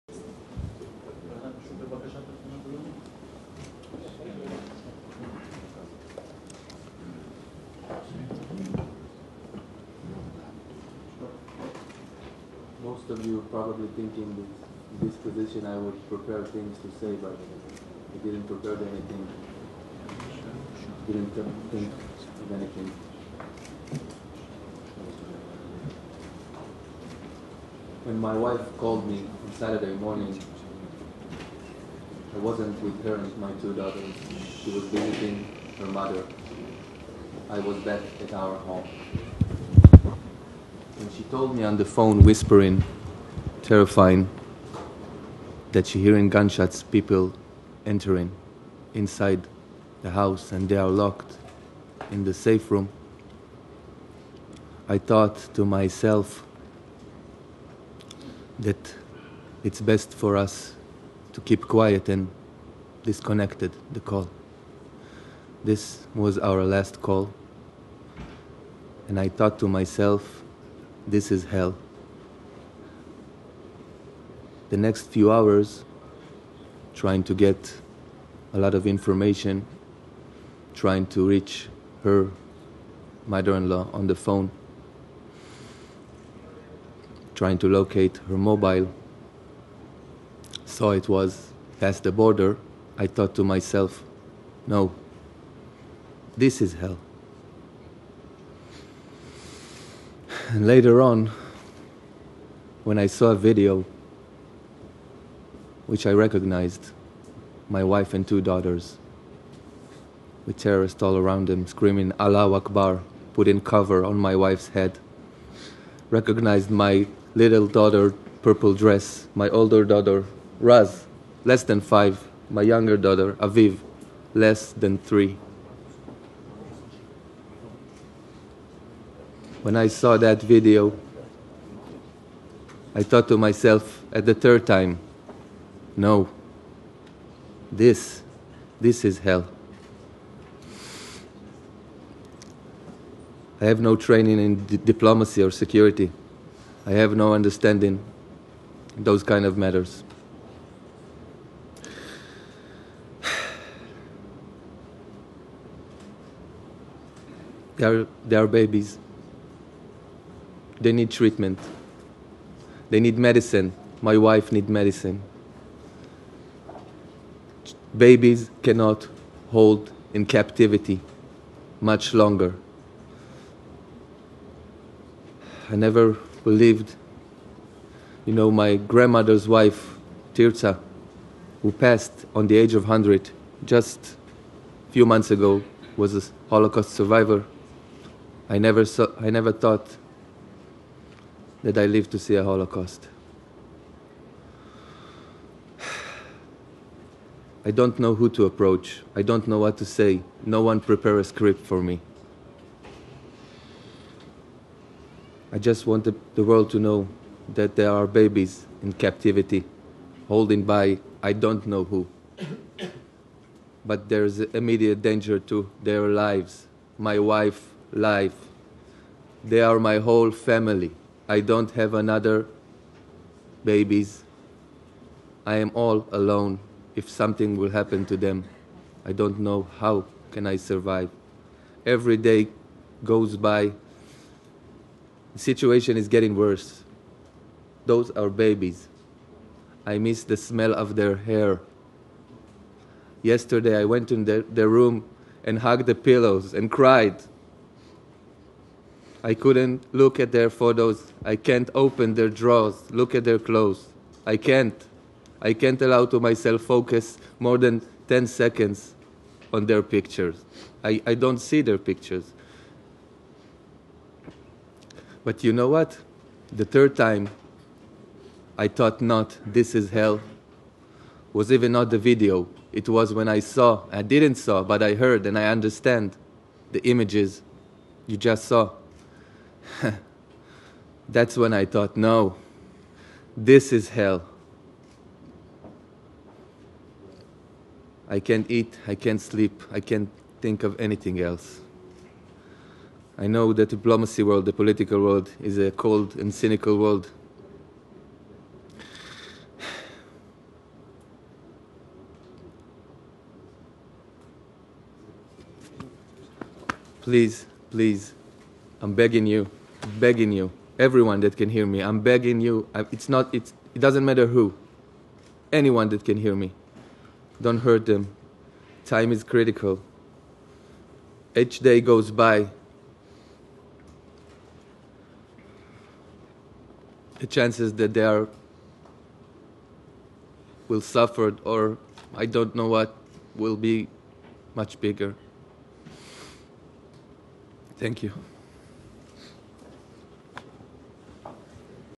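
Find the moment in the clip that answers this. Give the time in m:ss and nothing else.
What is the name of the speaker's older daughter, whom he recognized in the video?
2:00.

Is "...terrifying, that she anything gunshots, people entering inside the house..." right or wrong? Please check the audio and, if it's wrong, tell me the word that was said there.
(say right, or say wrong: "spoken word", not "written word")
wrong: "hearing", not "anything".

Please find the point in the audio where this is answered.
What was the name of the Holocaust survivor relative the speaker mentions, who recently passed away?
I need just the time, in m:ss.
3:00.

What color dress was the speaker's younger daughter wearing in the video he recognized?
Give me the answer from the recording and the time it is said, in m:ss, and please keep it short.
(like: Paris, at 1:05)
Purple, at 1:58.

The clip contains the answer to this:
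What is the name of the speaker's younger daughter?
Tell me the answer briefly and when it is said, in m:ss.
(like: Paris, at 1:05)
Aviv, at 2:03.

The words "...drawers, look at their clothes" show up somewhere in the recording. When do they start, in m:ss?
4:12.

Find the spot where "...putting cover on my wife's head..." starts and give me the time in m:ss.
1:53.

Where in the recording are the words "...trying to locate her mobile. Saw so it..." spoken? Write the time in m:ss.
1:27.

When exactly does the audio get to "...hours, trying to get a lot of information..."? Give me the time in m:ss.
1:15.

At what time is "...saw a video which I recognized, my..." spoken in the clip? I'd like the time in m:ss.
1:43.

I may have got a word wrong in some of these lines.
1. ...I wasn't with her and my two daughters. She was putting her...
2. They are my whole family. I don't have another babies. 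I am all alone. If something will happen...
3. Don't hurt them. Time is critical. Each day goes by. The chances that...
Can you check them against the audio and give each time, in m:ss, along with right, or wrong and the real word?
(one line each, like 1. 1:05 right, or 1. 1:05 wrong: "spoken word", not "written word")
1. 0:32 wrong: "visiting", not "putting"
2. 3:39 right
3. 5:17 right.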